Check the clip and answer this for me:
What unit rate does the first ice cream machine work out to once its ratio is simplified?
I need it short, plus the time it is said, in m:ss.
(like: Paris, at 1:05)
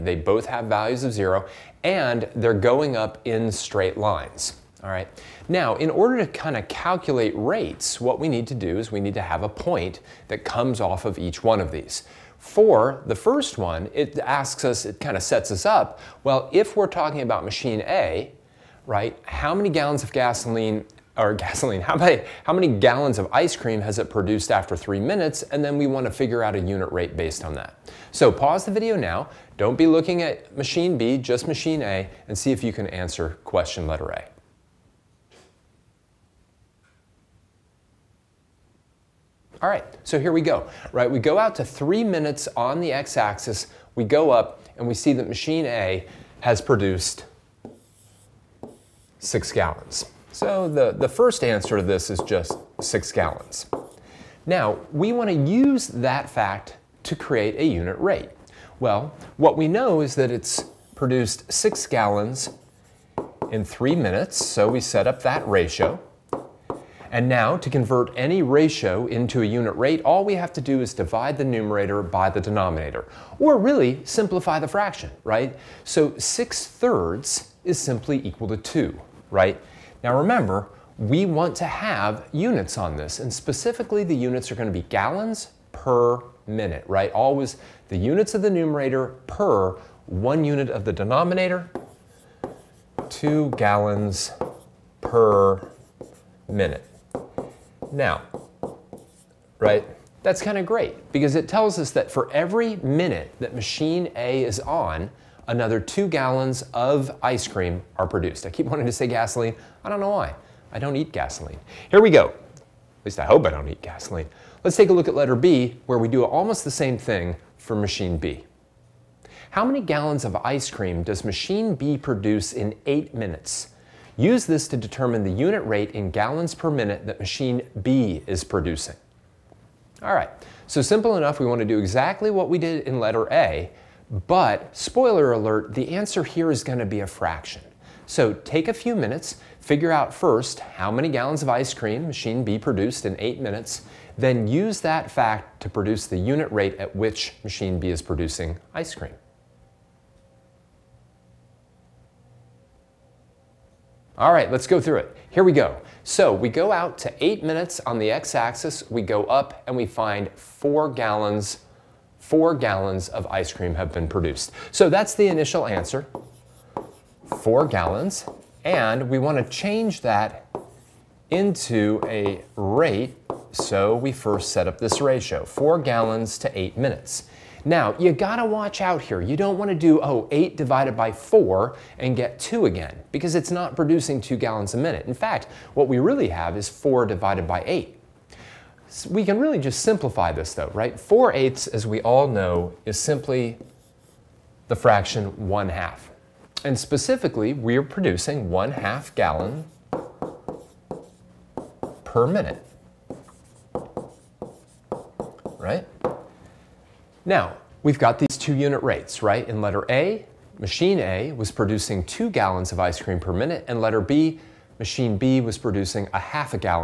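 2 gallons per minute, at 1:33.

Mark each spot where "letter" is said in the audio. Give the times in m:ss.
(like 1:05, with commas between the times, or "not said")
0:33, 1:55, 2:12, 3:29, 3:33.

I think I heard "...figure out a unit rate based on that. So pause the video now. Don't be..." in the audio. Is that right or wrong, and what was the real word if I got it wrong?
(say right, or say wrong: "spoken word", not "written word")
right.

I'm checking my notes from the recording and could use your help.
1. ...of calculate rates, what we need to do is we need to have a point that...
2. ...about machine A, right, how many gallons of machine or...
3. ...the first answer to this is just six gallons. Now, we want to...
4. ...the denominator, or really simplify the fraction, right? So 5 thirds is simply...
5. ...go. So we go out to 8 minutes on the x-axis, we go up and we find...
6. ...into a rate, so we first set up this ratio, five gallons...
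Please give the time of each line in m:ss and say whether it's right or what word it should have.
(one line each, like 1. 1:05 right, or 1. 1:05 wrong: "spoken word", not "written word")
1. 0:06 right
2. 0:17 wrong: "gasoline", not "machine"
3. 0:50 right
4. 1:12 wrong: "6", not "5"
5. 2:35 right
6. 2:51 wrong: "four", not "five".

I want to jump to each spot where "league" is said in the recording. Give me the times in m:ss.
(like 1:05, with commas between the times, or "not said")
not said.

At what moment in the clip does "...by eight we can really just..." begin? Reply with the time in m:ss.
3:07.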